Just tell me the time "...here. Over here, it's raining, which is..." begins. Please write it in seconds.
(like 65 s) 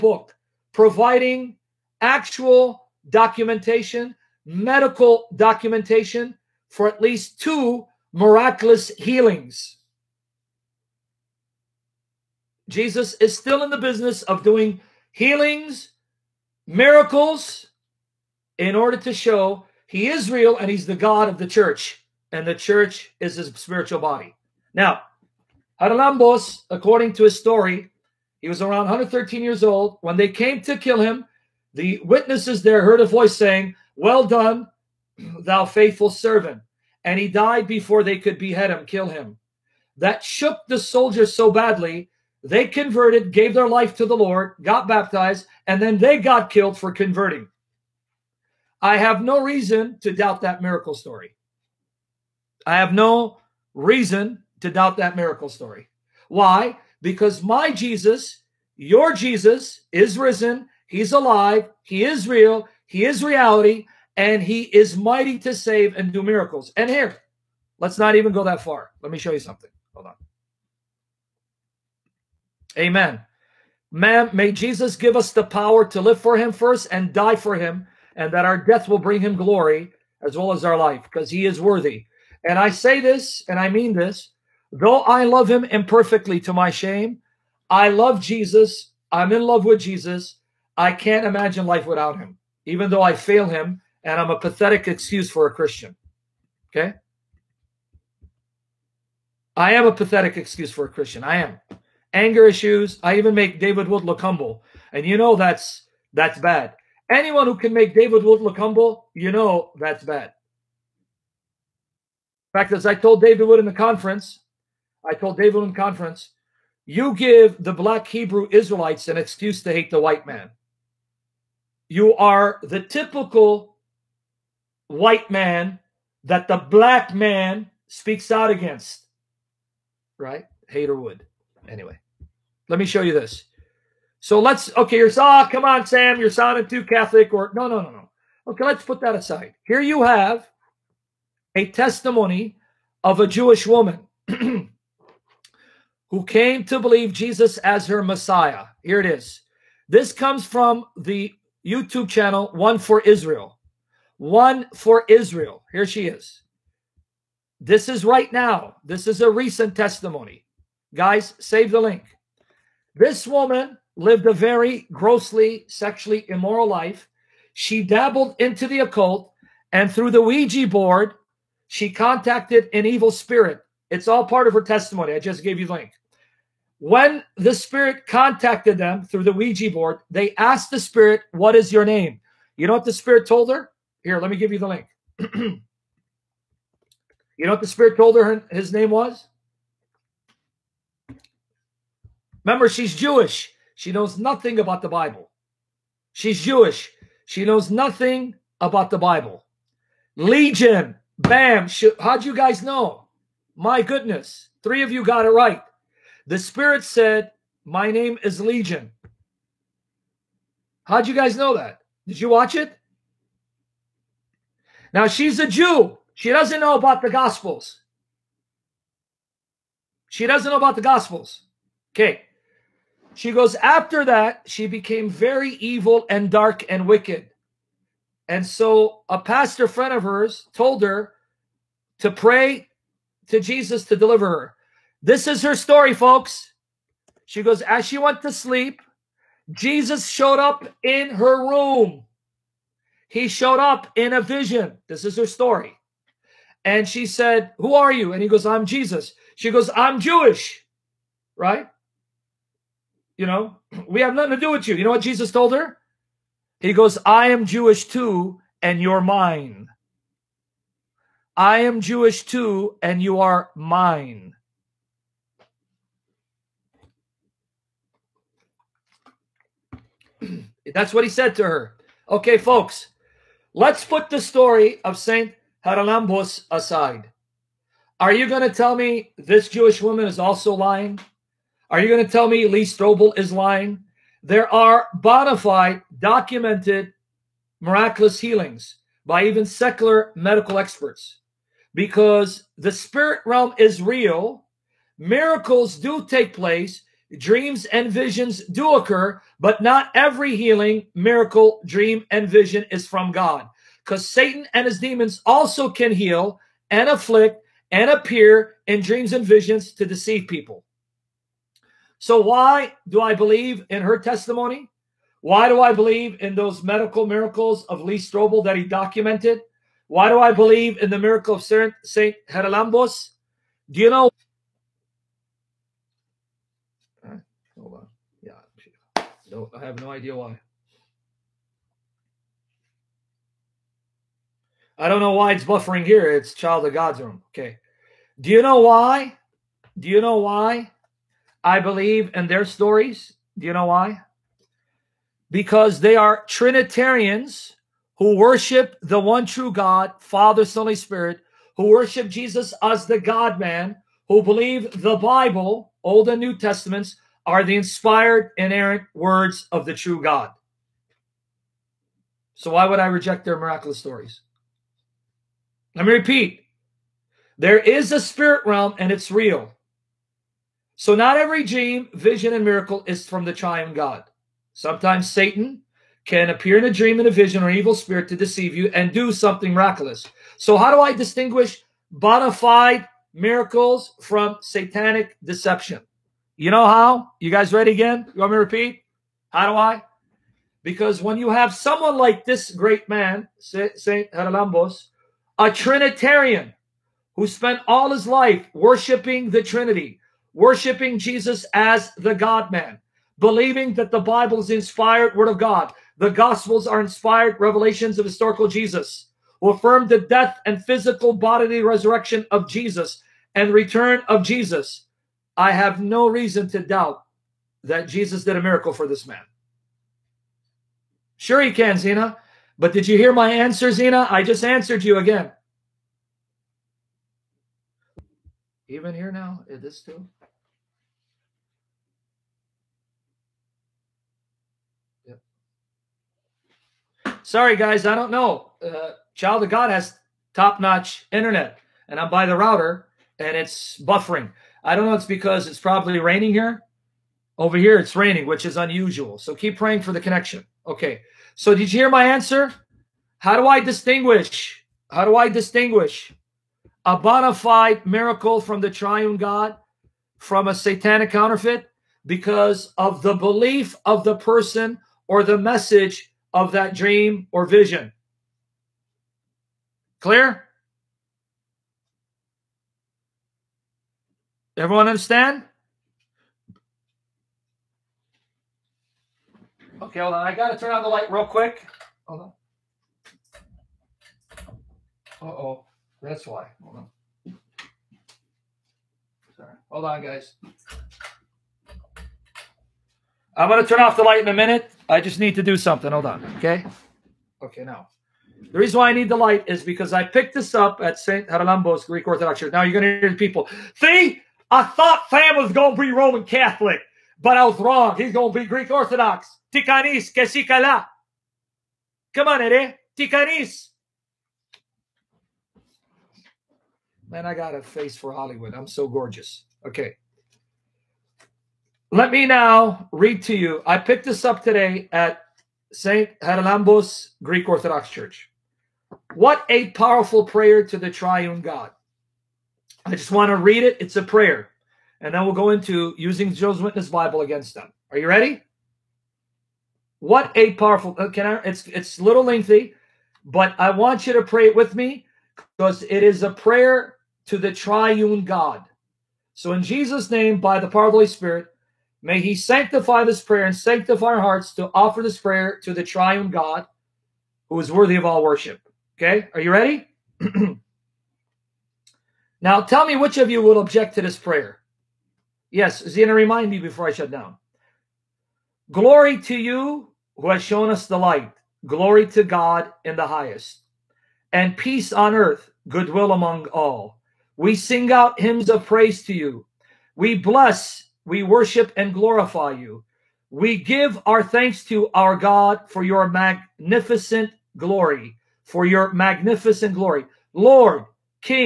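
446 s.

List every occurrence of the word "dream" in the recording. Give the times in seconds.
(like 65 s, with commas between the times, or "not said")
297 s, 301 s, 308 s, 371 s, 376 s, 466 s.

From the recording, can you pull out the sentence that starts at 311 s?
So, why do I believe in her testimony?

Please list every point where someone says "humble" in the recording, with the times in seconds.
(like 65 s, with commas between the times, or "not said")
104 s, 108 s.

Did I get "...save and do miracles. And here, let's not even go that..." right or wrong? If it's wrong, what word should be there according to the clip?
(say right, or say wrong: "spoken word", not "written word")
right.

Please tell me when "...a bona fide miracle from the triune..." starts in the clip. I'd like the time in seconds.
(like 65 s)
456 s.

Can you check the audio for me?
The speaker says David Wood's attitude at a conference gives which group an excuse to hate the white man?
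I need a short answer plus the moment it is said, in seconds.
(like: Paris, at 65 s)
Black Hebrew Israelites, at 117 s.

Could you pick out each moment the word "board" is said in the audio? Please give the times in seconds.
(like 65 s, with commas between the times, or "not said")
170 s, 179 s.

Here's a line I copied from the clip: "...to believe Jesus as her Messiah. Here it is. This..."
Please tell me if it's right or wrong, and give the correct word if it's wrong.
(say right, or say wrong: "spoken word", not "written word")
right.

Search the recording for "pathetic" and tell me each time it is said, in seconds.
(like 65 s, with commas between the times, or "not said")
94 s, 99 s.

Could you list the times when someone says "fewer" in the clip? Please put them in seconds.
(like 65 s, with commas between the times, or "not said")
not said.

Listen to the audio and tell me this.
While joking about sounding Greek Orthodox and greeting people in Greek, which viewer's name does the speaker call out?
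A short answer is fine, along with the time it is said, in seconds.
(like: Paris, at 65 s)
Eddie, at 512 s.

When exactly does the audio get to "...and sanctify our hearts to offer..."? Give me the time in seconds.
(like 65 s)
553 s.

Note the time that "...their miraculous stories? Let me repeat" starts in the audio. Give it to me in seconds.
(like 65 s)
363 s.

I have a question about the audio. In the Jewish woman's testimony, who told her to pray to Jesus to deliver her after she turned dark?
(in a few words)
A pastor friend.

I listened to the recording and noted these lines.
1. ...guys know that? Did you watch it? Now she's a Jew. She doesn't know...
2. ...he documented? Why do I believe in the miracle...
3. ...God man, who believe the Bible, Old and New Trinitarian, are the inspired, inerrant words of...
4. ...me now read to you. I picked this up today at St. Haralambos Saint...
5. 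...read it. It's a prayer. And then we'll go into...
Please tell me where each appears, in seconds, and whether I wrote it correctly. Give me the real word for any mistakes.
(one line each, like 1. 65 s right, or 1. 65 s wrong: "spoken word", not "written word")
1. 211 s right
2. 318 s right
3. 352 s wrong: "Testaments", not "Trinitarian"
4. 522 s wrong: "Greek", not "Saint"
5. 533 s right.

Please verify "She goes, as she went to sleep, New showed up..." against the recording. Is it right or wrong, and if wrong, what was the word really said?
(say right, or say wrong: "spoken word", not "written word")
wrong: "Jesus", not "New".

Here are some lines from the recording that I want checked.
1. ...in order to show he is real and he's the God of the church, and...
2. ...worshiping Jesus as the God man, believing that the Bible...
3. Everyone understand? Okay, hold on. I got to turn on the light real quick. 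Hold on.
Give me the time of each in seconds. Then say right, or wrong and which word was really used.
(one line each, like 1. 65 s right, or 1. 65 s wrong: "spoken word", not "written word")
1. 18 s right
2. 400 s right
3. 474 s right.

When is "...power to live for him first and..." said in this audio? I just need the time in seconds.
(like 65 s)
75 s.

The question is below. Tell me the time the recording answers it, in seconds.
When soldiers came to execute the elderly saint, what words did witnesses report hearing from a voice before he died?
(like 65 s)
33 s.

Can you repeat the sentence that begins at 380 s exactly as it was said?
So how do I distinguish bona fide miracles from satanic deception?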